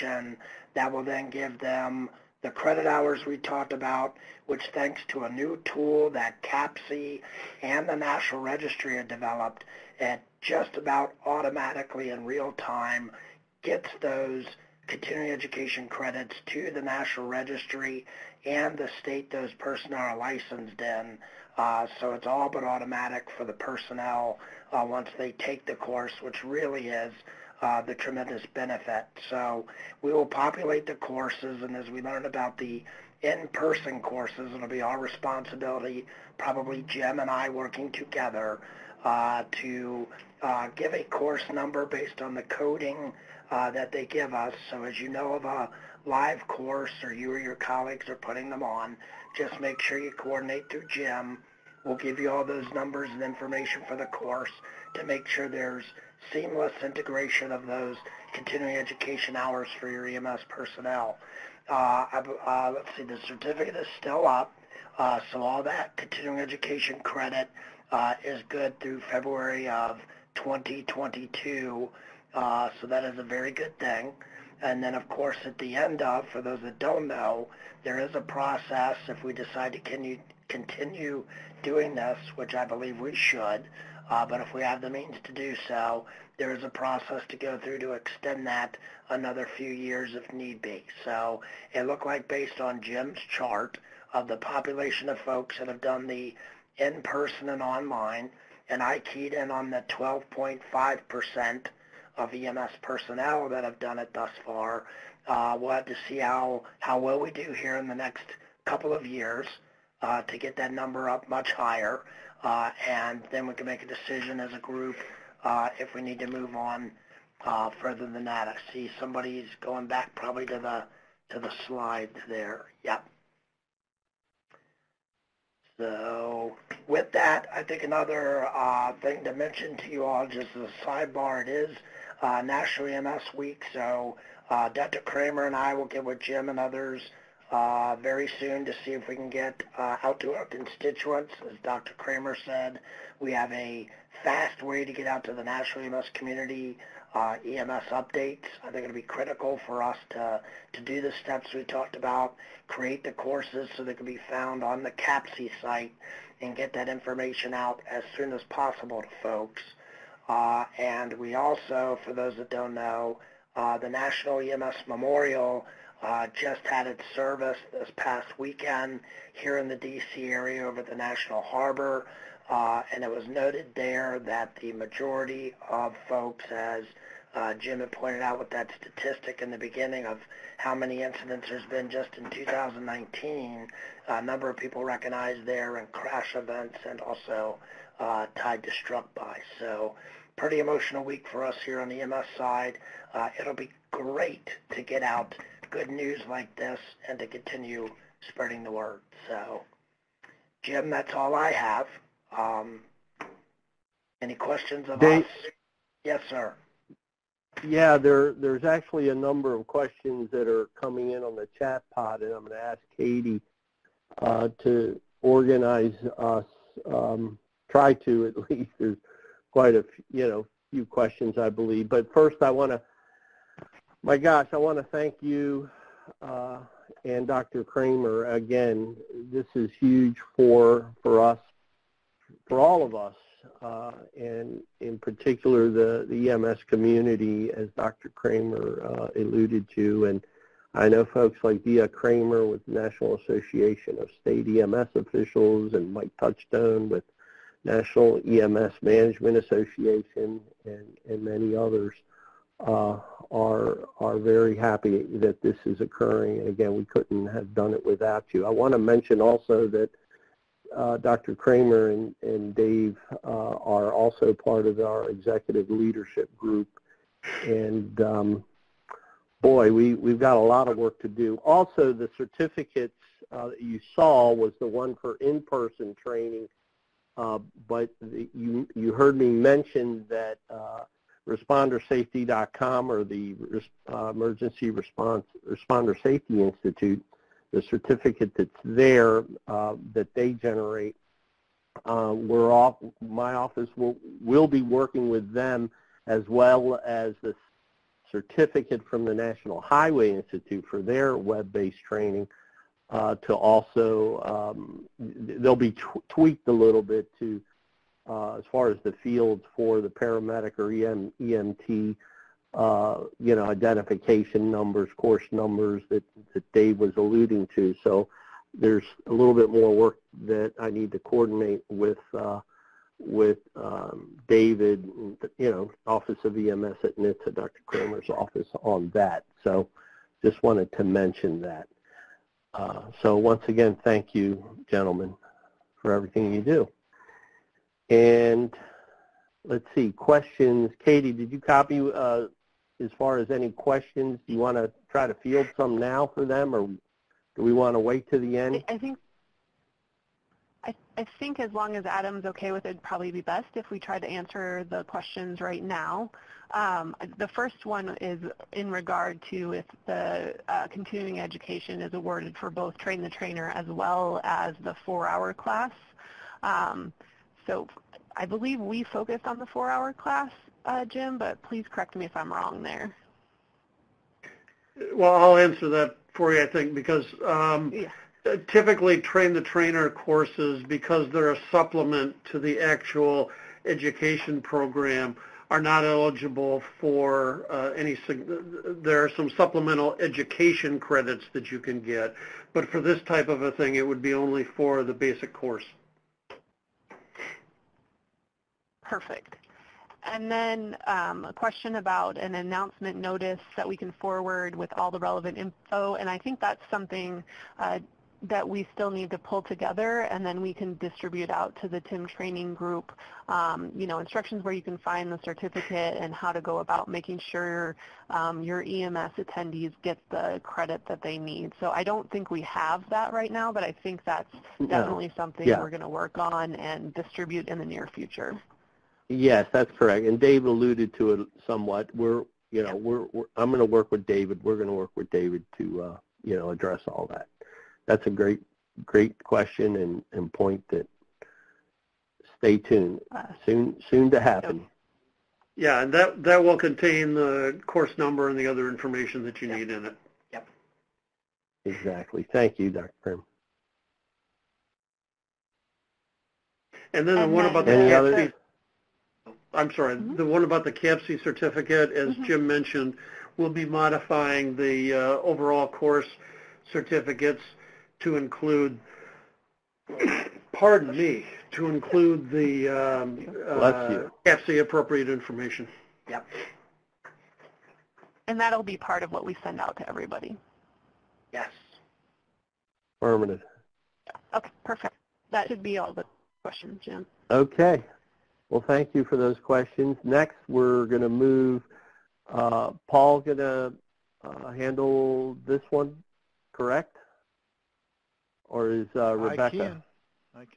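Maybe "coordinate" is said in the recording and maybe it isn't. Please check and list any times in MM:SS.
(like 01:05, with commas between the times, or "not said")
00:50, 05:21.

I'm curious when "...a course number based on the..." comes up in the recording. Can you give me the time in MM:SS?
00:40.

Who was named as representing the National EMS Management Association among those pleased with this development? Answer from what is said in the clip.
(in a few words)
Mike Touchstone.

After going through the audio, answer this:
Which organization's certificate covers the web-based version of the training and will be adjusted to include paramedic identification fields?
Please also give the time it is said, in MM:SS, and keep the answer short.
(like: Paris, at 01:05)
National Highway Institute, at 04:59.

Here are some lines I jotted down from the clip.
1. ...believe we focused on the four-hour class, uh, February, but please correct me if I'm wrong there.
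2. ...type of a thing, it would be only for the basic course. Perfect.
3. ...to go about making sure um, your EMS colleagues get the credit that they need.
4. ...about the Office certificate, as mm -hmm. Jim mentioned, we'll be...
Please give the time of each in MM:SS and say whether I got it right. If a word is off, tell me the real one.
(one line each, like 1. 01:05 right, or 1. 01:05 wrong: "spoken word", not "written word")
1. 06:08 wrong: "Jim", not "February"
2. 06:33 right
3. 06:56 wrong: "attendees", not "colleagues"
4. 07:40 wrong: "CAPCE", not "Office".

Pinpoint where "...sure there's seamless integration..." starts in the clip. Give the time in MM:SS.
00:55.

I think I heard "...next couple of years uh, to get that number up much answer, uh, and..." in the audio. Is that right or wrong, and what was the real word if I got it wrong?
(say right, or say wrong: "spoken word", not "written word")
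wrong: "higher", not "answer".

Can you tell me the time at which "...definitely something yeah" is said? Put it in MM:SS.
07:04.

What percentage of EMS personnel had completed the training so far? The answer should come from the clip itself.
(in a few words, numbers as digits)
12.5%.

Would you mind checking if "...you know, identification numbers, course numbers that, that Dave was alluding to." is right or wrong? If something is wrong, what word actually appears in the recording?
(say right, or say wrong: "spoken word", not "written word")
right.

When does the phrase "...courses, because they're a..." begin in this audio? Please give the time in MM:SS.
06:19.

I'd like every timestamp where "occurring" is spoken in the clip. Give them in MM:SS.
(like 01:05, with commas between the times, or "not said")
04:15.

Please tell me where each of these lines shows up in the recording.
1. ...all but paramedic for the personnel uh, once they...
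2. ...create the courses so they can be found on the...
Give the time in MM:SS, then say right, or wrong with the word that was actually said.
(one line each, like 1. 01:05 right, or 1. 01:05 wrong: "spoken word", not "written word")
1. 00:22 wrong: "automatic", not "paramedic"
2. 02:32 right.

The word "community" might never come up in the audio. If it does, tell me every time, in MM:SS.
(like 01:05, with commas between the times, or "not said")
02:26, 03:56.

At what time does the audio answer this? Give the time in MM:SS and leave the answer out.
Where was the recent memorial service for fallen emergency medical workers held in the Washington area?
02:50.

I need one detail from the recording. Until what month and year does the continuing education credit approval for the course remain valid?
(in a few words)
February 2022.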